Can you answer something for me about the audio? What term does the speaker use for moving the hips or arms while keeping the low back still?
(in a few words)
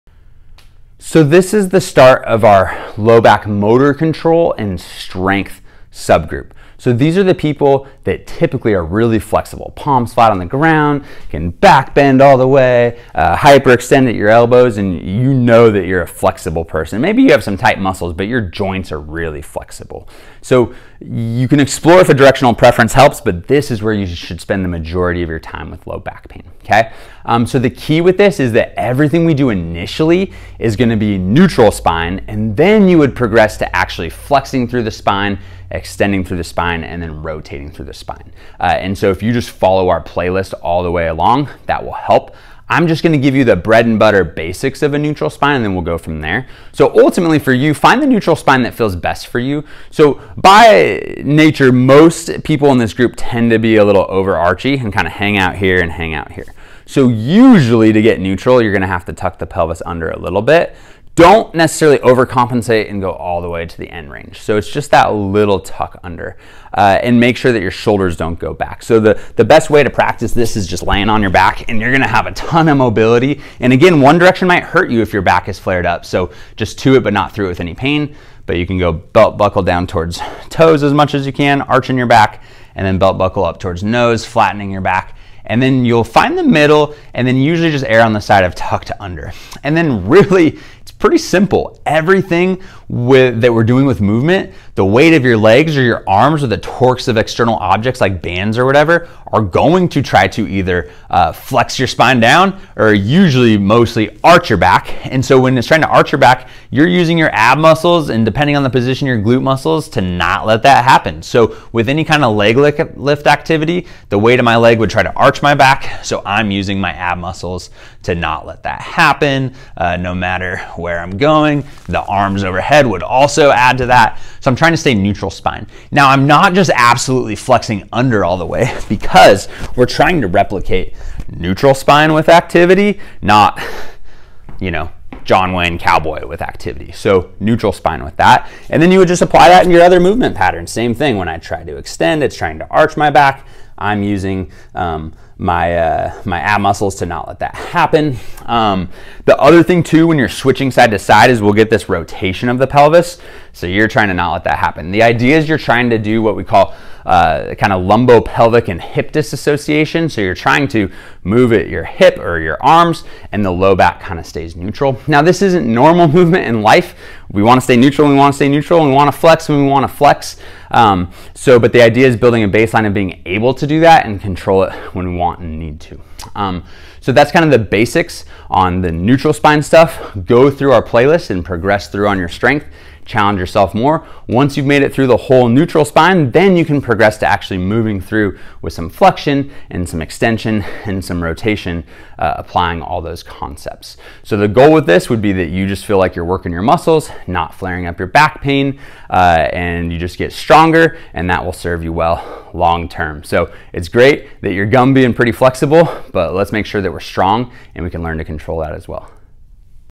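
lumbo pelvic and hip disassociation.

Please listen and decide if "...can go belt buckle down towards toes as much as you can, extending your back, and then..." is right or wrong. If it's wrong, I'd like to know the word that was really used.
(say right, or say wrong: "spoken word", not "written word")
wrong: "arching", not "extending".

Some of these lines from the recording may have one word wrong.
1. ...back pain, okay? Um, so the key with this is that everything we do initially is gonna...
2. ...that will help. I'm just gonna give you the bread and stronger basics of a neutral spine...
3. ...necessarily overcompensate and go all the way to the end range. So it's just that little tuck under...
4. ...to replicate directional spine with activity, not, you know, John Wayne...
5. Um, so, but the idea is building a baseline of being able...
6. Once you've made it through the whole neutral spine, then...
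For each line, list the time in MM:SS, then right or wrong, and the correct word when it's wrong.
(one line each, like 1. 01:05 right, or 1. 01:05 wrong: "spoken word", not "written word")
1. 00:25 right
2. 00:41 wrong: "butter", not "stronger"
3. 01:01 right
4. 02:10 wrong: "neutral", not "directional"
5. 02:50 right
6. 03:04 right.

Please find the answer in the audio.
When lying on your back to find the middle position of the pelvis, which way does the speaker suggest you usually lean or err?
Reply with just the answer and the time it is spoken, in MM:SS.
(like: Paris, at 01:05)
tucked under, at 01:28.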